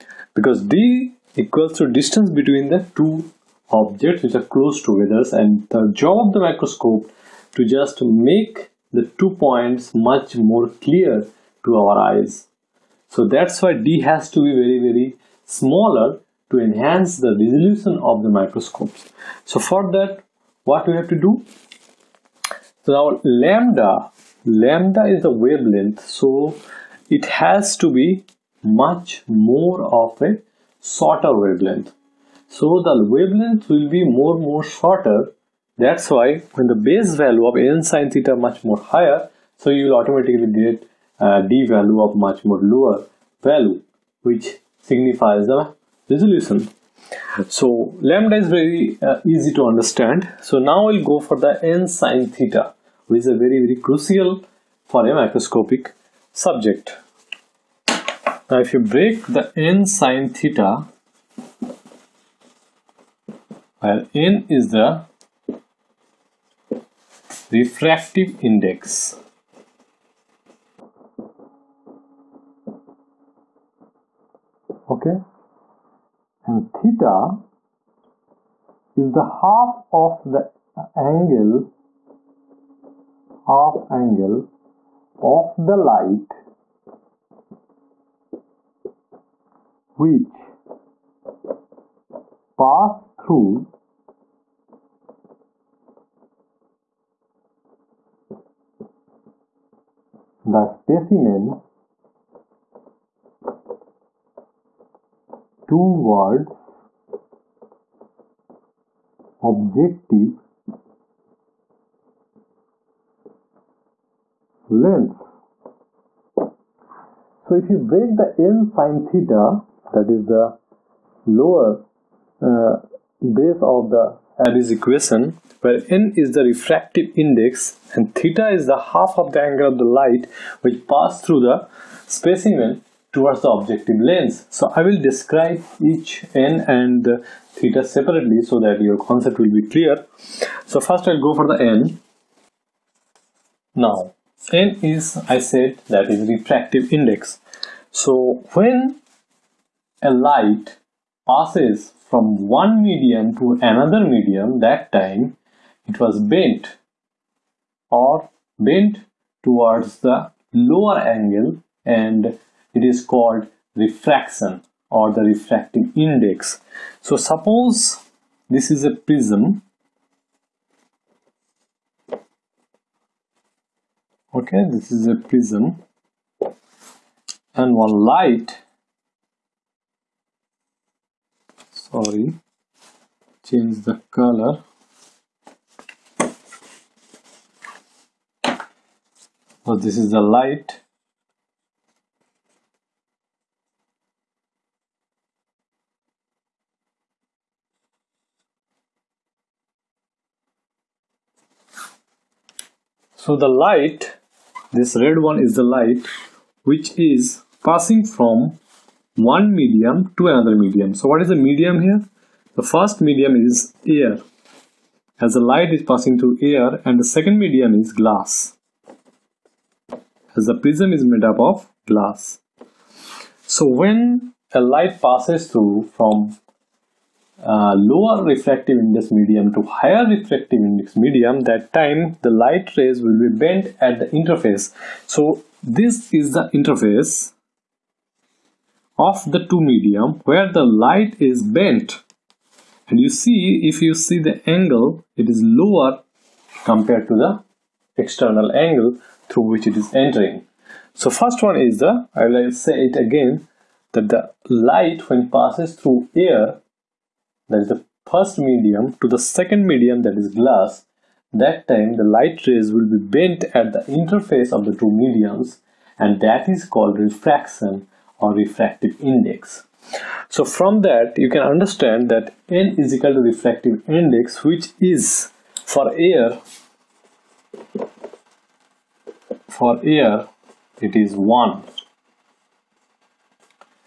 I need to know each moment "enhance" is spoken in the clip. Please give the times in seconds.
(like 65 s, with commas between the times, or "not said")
16 s.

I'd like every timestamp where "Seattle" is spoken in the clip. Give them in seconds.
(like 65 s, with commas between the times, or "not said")
not said.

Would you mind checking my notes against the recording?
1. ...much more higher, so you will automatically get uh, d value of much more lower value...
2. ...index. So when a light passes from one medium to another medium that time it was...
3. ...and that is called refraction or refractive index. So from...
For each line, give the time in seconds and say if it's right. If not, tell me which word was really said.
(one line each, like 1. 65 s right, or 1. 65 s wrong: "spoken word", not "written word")
1. 38 s right
2. 146 s right
3. 265 s right.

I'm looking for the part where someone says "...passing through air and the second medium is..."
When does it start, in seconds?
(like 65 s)
215 s.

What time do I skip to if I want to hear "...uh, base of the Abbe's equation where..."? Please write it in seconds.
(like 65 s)
122 s.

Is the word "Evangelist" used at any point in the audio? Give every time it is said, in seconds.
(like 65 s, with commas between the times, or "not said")
not said.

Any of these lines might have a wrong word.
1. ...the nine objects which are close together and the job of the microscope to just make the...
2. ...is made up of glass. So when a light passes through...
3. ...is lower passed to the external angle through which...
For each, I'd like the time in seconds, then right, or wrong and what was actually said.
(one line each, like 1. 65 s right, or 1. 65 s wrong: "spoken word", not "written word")
1. 2 s wrong: "two", not "nine"
2. 220 s right
3. 245 s wrong: "compared", not "passed".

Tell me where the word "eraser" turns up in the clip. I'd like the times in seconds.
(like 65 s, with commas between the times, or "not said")
not said.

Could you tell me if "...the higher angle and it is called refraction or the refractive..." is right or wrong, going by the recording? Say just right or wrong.
wrong.